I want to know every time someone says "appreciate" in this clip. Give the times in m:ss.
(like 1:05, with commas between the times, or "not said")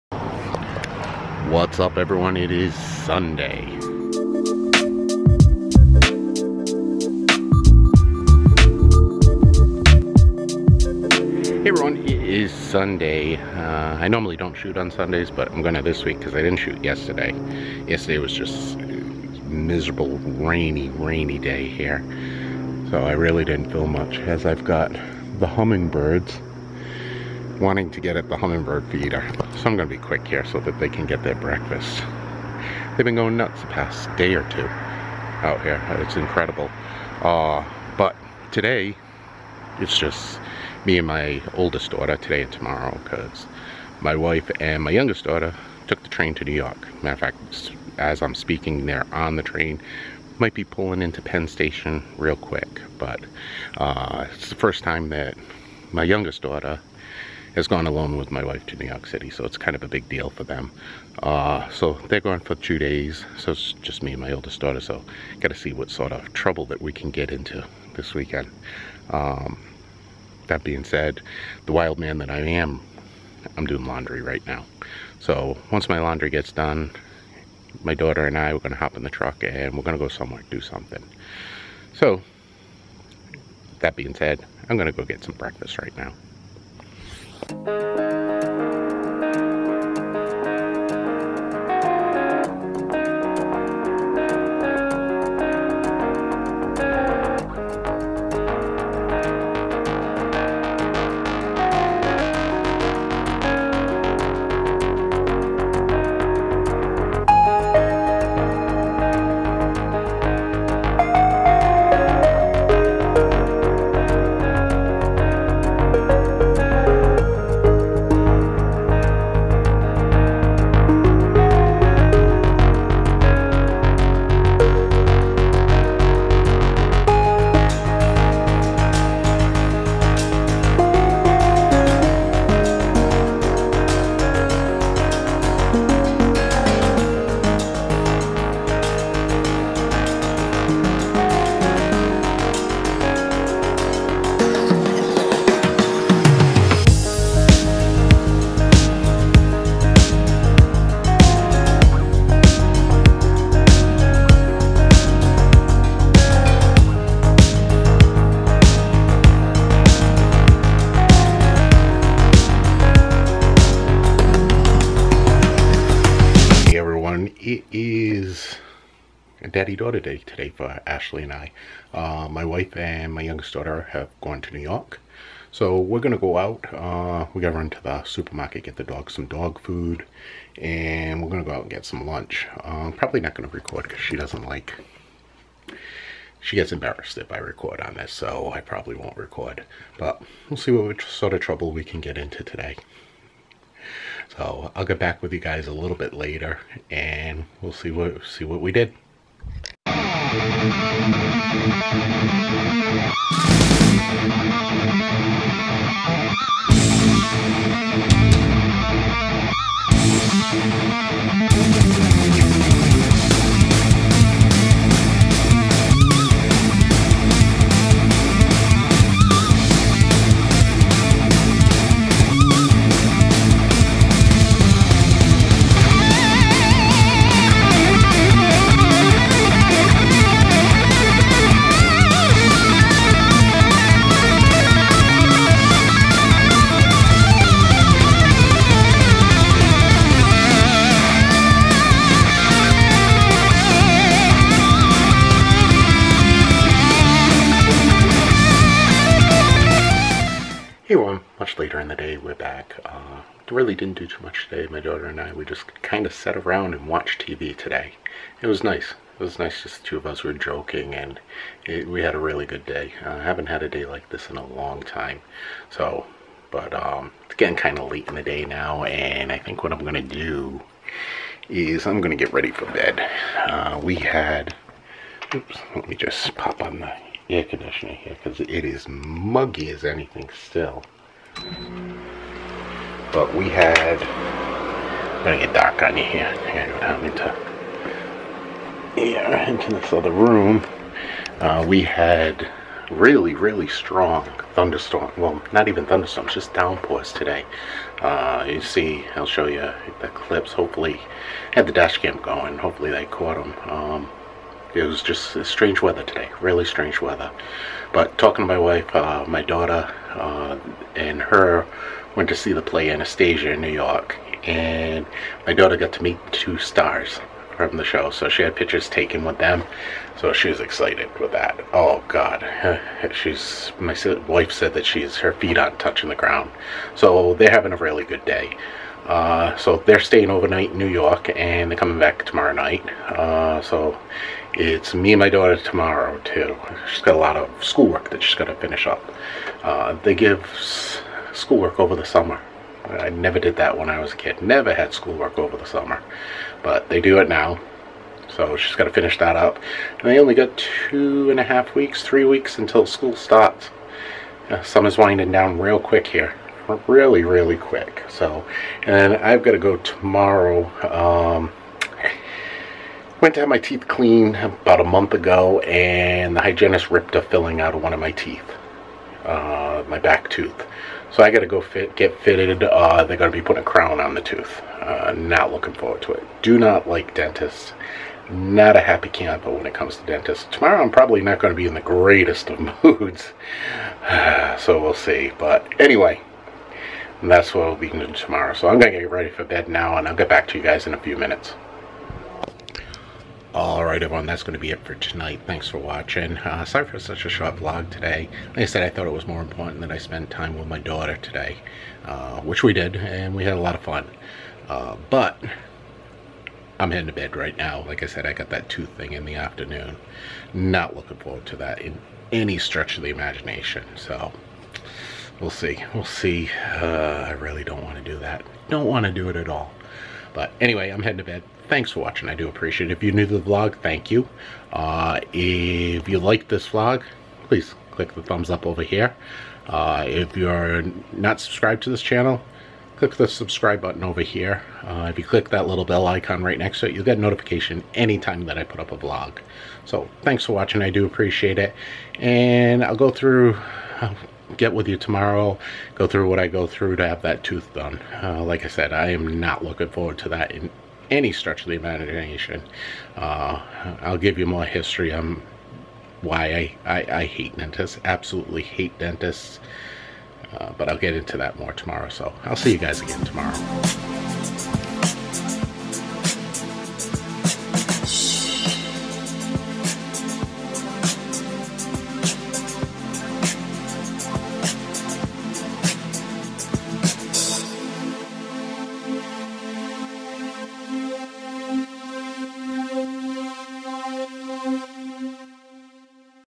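7:02, 7:21.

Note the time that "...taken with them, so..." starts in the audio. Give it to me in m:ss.
5:18.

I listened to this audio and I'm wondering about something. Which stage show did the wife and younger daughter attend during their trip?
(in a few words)
Anastasia.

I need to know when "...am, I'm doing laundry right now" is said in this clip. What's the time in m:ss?
1:12.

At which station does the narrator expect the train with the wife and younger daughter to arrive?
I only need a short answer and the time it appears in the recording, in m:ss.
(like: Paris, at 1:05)
Penn Station, at 0:51.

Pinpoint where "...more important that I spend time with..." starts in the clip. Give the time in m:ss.
6:39.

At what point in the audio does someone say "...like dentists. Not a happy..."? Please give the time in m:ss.
6:16.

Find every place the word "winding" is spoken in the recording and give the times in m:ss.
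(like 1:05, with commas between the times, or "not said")
5:54.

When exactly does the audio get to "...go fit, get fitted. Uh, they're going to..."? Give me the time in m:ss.
6:11.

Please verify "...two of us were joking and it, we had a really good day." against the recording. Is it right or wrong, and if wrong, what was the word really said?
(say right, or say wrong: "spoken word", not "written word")
right.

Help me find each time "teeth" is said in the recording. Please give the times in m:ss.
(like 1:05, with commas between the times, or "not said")
6:03, 6:08.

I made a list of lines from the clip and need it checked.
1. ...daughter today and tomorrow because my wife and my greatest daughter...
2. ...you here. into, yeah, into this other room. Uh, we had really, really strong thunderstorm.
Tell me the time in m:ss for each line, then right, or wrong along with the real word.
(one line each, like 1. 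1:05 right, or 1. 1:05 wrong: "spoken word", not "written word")
1. 0:41 wrong: "youngest", not "greatest"
2. 4:45 right.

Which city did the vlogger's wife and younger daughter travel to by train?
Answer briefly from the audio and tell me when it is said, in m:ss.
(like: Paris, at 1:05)
New York City, at 0:58.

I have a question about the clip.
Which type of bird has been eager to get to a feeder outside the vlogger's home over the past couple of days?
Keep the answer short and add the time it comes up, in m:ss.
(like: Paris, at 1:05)
Hummingbirds, at 0:25.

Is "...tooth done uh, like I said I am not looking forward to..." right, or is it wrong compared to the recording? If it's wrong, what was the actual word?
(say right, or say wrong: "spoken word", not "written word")
right.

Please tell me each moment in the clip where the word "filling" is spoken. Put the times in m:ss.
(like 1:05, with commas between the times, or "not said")
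6:07.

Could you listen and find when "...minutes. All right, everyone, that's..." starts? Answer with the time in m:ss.
6:31.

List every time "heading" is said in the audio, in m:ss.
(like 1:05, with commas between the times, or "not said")
6:46, 7:01.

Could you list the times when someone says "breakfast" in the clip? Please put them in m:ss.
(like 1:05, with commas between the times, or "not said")
0:31, 1:25.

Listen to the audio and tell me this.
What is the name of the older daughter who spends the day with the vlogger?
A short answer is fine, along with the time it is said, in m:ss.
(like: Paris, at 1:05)
Ashley, at 2:50.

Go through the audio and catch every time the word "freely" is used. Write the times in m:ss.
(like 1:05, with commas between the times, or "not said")
not said.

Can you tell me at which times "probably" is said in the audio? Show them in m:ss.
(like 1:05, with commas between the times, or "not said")
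3:02, 3:08, 6:20.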